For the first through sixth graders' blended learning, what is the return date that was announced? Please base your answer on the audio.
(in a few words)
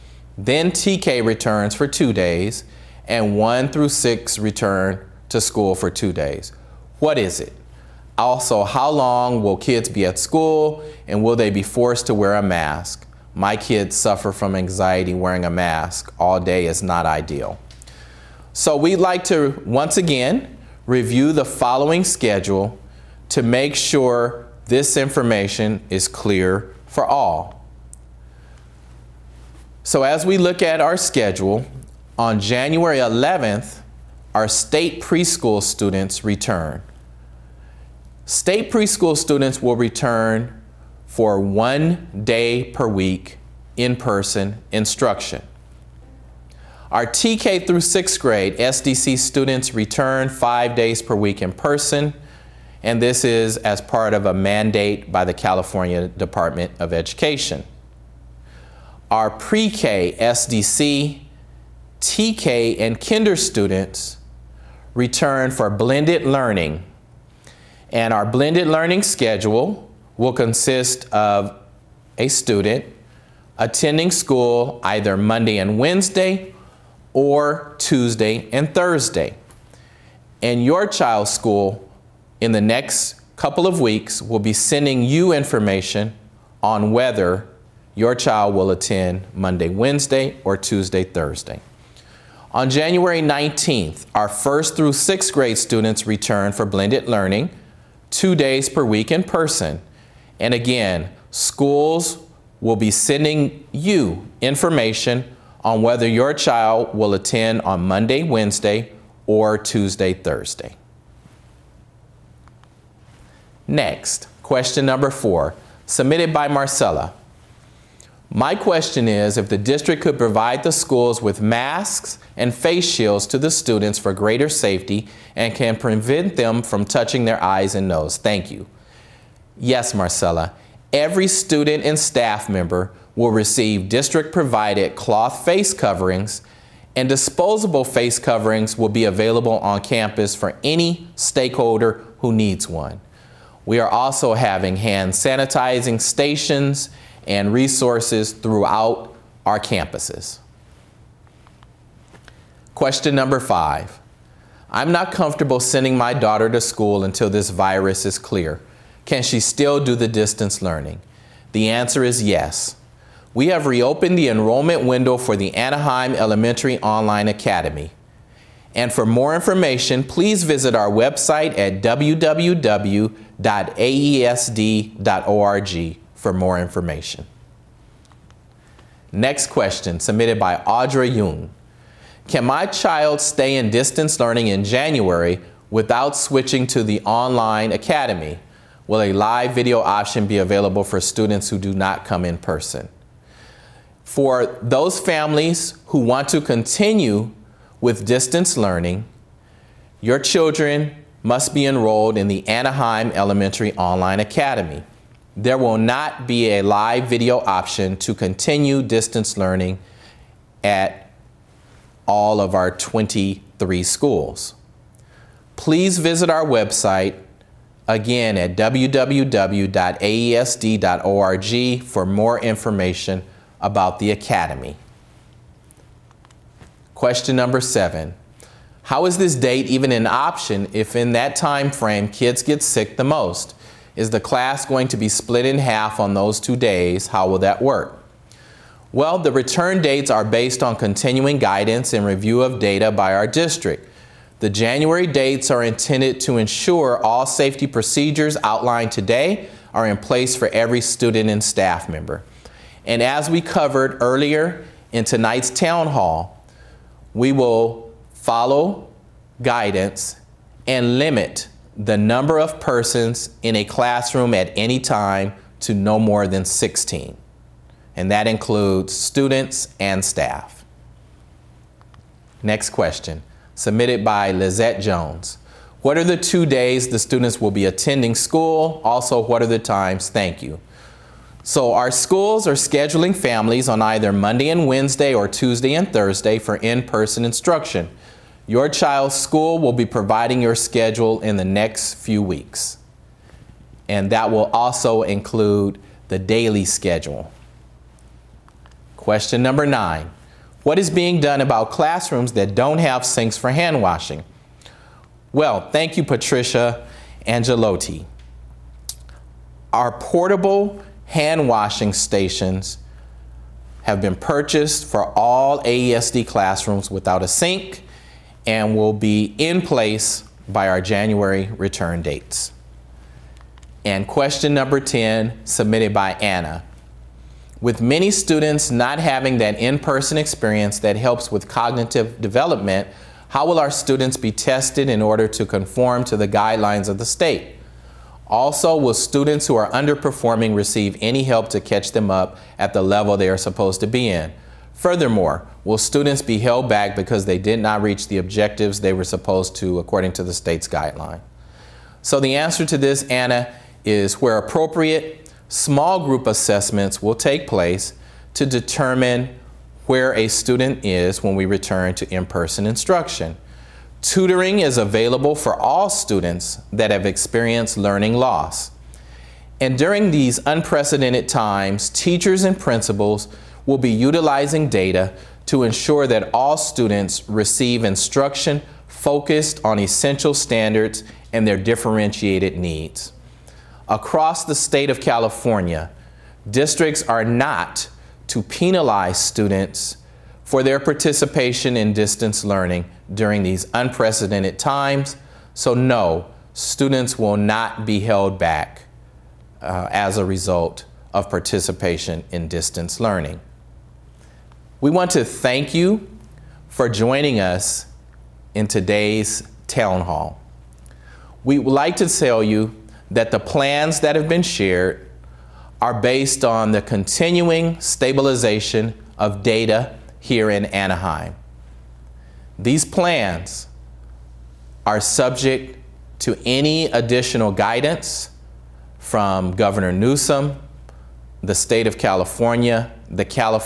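January 19th.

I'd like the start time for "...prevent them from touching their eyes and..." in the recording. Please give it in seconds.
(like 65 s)
125 s.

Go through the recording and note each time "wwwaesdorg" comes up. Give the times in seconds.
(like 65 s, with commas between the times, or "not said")
171 s, 218 s.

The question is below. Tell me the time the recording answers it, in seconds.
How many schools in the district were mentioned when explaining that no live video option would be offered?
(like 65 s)
212 s.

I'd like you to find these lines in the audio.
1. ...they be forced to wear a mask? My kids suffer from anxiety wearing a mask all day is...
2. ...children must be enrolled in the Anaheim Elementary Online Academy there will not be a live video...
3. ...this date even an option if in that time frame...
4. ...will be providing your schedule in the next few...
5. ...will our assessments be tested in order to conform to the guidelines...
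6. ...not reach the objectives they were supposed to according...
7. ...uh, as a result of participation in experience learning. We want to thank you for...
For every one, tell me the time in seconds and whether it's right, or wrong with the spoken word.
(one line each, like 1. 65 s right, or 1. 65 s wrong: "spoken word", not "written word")
1. 11 s right
2. 200 s right
3. 229 s right
4. 289 s right
5. 333 s wrong: "students", not "assessments"
6. 347 s right
7. 399 s wrong: "distance", not "experience".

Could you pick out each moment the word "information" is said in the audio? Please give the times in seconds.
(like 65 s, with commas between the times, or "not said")
24 s, 85 s, 104 s, 169 s, 176 s, 222 s.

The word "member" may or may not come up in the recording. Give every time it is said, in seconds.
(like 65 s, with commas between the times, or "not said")
132 s, 251 s.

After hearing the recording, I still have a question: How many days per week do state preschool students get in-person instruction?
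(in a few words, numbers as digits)
1.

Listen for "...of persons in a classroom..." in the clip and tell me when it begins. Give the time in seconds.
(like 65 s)
262 s.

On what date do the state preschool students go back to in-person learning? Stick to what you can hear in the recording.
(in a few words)
January 11th.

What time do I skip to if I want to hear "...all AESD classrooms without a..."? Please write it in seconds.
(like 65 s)
315 s.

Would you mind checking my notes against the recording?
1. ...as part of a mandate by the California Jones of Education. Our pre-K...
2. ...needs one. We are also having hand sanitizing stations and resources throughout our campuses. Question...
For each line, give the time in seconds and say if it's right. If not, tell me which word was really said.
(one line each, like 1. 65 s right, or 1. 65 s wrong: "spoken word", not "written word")
1. 53 s wrong: "Department", not "Jones"
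2. 142 s right.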